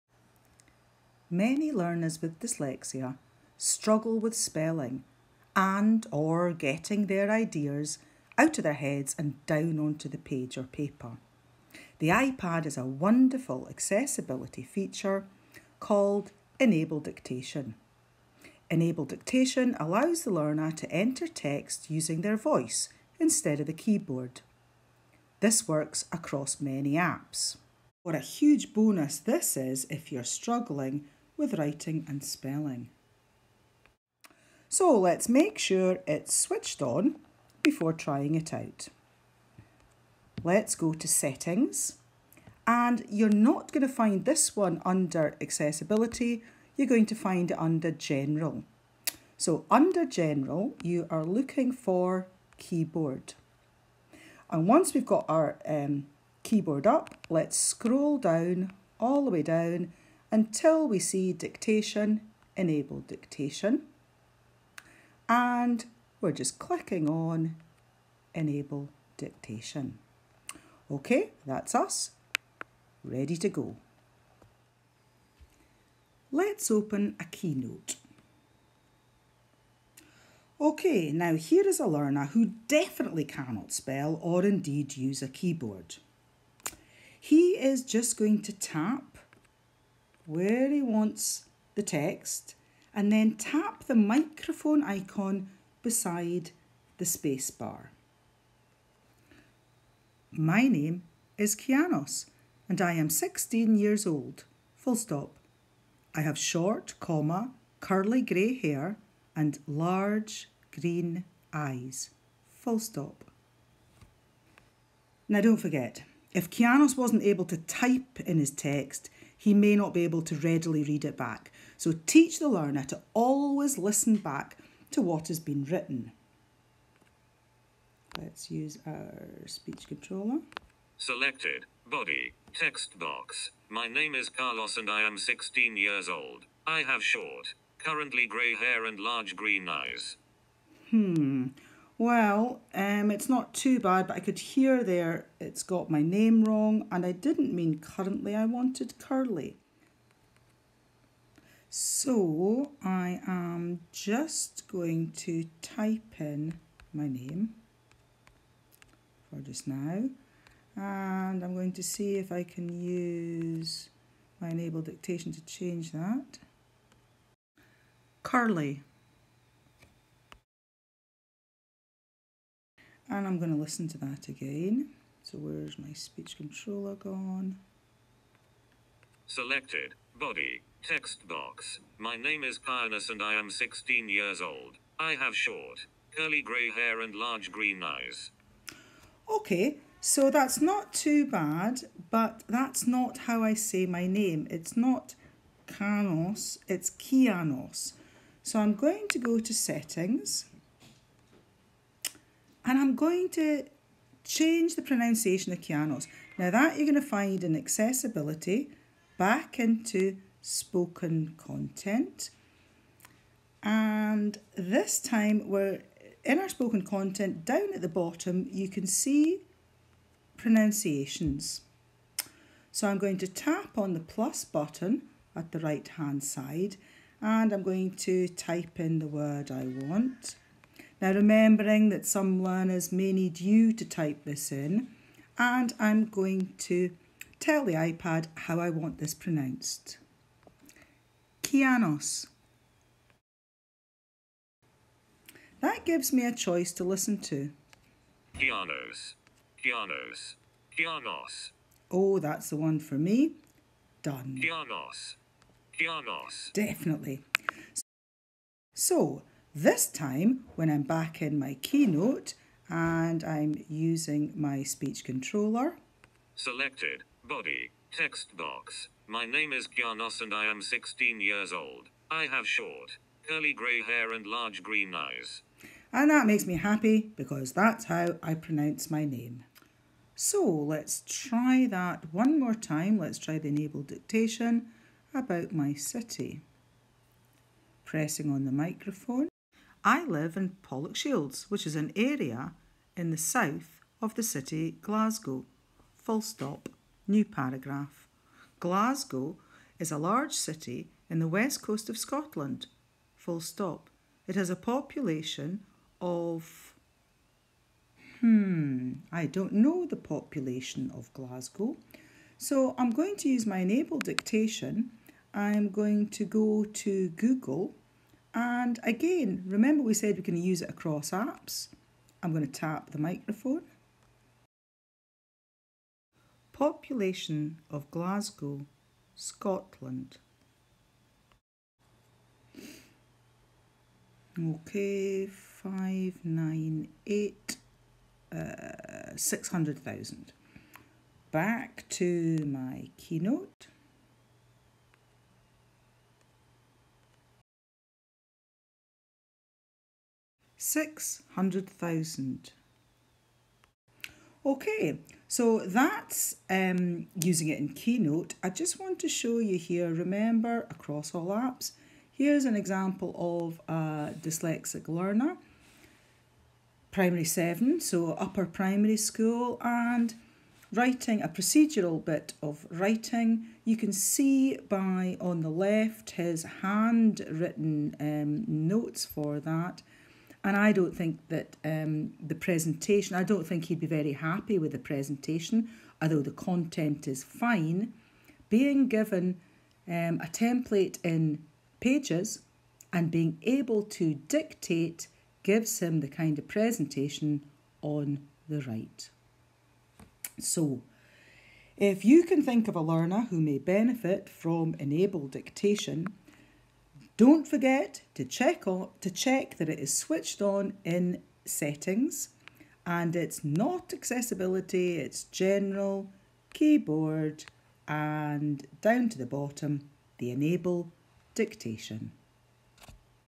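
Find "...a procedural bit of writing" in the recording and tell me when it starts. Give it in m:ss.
6:11.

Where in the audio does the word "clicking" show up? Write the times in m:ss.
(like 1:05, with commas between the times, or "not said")
1:06.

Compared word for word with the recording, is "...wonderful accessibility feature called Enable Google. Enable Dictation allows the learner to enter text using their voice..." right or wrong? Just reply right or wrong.
wrong.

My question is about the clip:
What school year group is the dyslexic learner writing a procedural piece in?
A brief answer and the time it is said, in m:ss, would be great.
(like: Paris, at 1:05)
Primary seven, at 6:06.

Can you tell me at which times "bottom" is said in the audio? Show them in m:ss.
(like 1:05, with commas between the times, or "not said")
3:37, 6:59.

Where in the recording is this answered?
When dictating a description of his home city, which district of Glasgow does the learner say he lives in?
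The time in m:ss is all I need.
4:50.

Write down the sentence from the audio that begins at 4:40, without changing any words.
So let's try that one more time.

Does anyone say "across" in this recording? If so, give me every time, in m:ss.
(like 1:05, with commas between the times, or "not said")
0:26, 5:20, 6:00.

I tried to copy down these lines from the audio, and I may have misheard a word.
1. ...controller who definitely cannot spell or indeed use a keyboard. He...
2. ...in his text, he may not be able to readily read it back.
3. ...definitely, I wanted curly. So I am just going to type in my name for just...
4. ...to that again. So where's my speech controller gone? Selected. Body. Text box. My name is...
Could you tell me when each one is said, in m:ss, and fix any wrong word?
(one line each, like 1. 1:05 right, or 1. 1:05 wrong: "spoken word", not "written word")
1. 1:21 wrong: "learner", not "controller"
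2. 1:58 right
3. 2:27 wrong: "currently", not "definitely"
4. 2:53 right.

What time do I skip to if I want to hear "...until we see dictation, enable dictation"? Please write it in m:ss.
1:00.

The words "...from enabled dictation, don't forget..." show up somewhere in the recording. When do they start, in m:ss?
6:44.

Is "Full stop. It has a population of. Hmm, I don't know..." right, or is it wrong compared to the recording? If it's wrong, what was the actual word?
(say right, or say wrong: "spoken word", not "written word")
right.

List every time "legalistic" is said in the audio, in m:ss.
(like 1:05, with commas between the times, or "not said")
not said.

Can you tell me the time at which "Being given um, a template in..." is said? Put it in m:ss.
6:28.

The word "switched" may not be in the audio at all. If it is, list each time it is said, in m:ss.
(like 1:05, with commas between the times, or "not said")
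0:36, 6:49.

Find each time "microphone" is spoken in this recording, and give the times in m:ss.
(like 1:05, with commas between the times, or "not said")
1:33, 4:48, 5:22.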